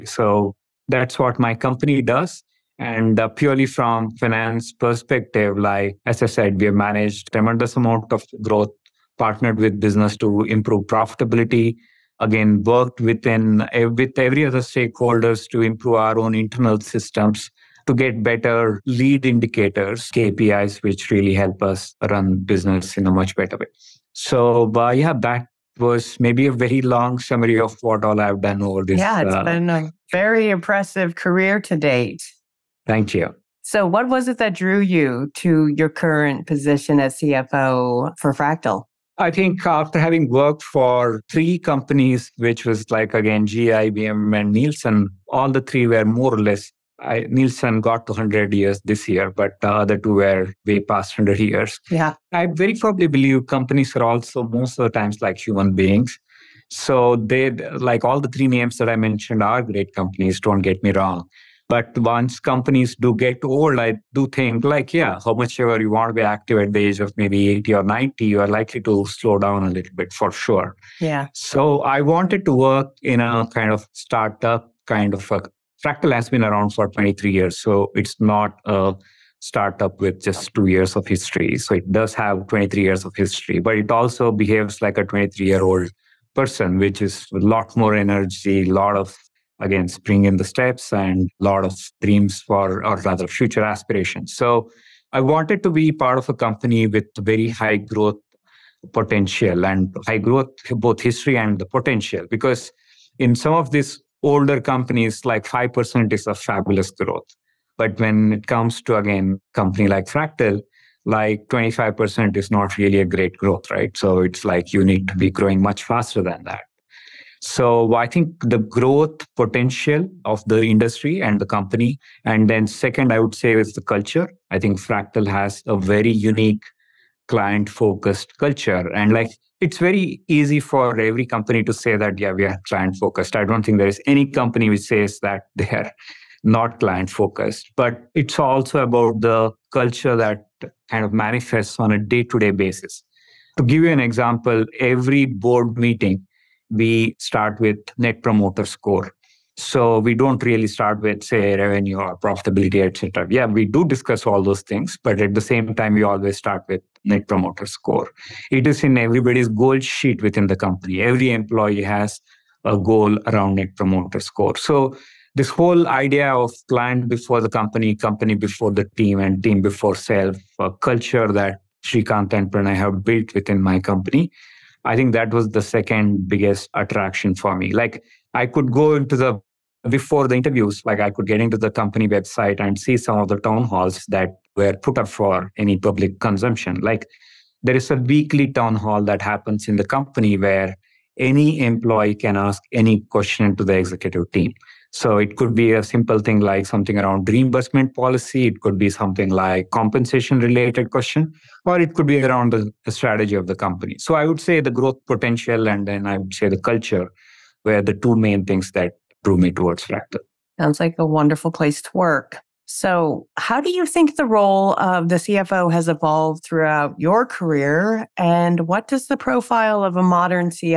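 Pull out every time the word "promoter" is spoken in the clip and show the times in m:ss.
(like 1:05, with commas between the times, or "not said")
2:28, 2:37, 2:43.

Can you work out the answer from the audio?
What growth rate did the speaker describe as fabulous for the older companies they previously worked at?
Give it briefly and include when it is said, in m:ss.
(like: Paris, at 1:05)
5%, at 1:45.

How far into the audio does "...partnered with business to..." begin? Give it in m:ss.
0:09.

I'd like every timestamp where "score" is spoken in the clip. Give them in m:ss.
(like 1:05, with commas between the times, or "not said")
2:28, 2:37, 2:44.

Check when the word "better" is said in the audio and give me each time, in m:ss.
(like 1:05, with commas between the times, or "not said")
0:18, 0:23.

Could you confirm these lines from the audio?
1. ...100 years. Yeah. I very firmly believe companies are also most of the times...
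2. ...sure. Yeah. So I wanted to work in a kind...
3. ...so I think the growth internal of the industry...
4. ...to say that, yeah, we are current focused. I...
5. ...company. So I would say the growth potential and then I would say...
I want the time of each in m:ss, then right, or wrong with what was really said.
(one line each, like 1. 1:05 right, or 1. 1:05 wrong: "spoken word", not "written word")
1. 0:51 right
2. 1:10 right
3. 1:57 wrong: "potential", not "internal"
4. 2:11 wrong: "client", not "current"
5. 3:23 right.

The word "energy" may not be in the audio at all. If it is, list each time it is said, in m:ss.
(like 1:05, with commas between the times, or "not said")
1:27.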